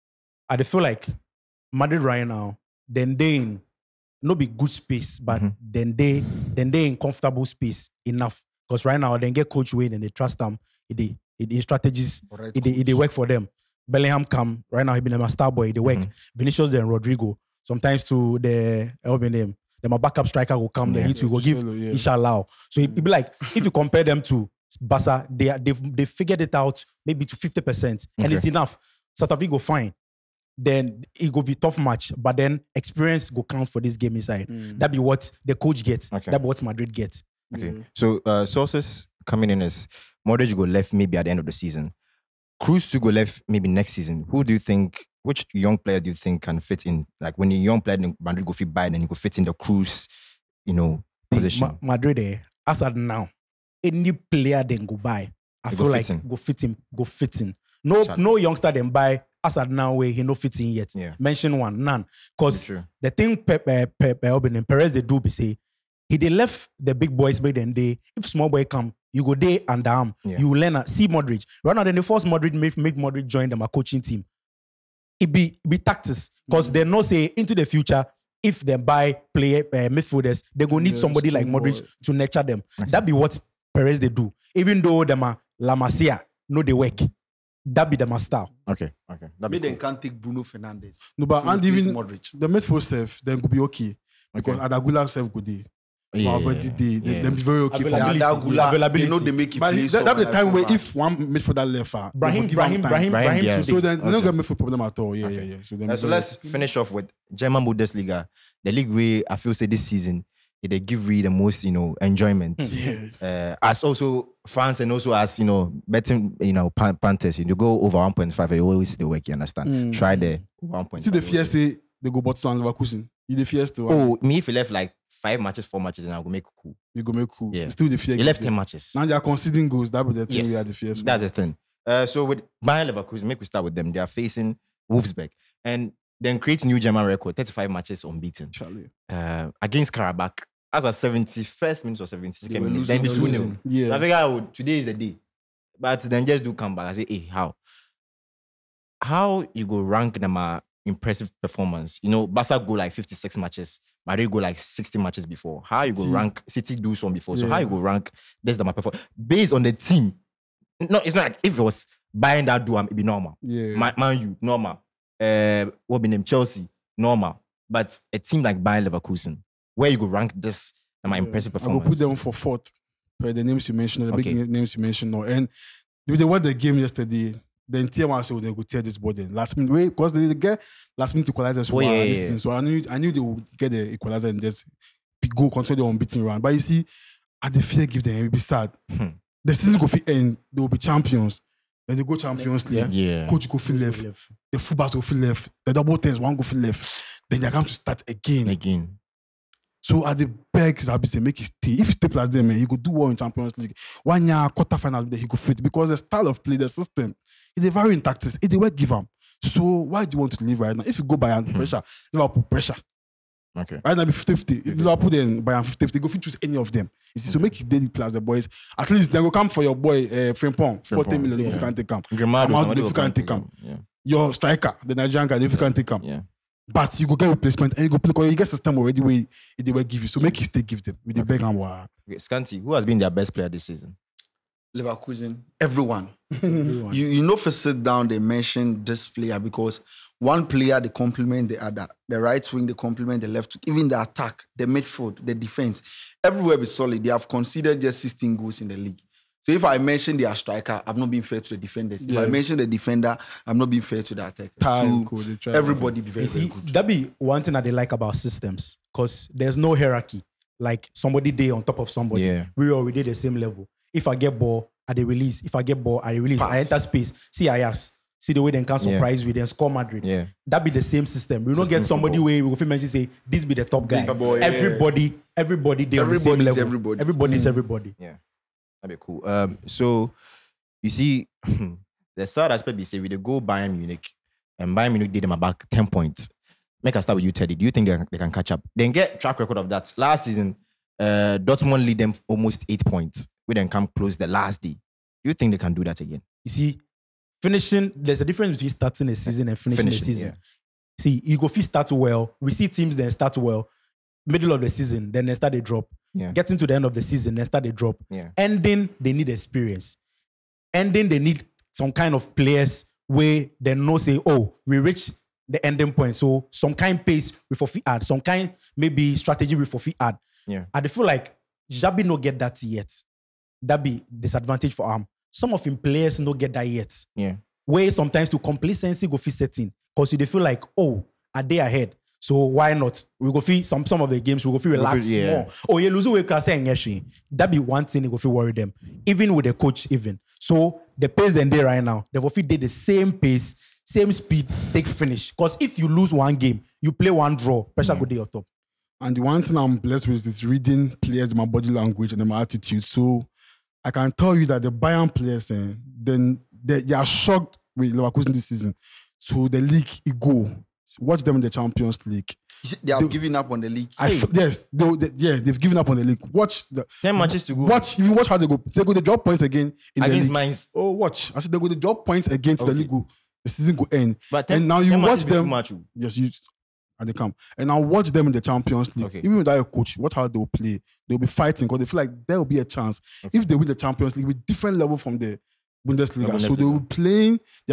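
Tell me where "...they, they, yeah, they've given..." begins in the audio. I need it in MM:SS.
06:04.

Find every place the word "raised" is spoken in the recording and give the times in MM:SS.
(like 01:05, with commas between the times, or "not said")
not said.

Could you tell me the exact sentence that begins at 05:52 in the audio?
So I can tell you that the Bayern players, eh, then they, they, are shocked with Leverkusen this season.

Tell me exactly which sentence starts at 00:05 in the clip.
then they then they in comfortable space enough.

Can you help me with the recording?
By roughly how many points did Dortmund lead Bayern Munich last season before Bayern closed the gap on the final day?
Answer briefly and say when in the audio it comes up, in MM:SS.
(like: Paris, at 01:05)
8, at 04:52.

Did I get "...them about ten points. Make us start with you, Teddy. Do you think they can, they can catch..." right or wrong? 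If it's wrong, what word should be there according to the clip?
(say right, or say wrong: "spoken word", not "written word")
right.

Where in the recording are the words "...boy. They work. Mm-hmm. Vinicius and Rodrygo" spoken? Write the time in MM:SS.
00:15.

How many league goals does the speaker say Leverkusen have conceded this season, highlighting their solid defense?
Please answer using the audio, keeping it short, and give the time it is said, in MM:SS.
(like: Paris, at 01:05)
16, at 04:08.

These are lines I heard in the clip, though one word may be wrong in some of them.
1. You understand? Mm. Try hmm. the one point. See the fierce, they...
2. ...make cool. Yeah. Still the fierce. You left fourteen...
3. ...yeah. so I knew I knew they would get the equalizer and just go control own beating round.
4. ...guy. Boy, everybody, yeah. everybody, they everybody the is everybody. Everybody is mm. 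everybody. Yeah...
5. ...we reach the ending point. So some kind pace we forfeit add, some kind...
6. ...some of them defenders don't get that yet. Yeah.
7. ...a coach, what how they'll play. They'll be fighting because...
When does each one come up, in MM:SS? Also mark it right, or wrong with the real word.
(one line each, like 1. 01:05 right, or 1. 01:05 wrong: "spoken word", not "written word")
1. 01:59 right
2. 02:07 wrong: "ten", not "fourteen"
3. 03:02 right
4. 04:33 right
5. 05:14 right
6. 05:25 wrong: "players", not "defenders"
7. 06:19 right.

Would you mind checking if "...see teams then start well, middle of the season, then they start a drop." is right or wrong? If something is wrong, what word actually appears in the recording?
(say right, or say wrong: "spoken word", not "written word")
right.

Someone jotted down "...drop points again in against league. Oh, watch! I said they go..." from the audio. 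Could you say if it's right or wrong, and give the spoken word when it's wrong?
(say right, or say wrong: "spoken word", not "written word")
right.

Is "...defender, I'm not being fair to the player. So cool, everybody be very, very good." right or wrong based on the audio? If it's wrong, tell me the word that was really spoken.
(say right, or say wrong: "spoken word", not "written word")
wrong: "attacker", not "player".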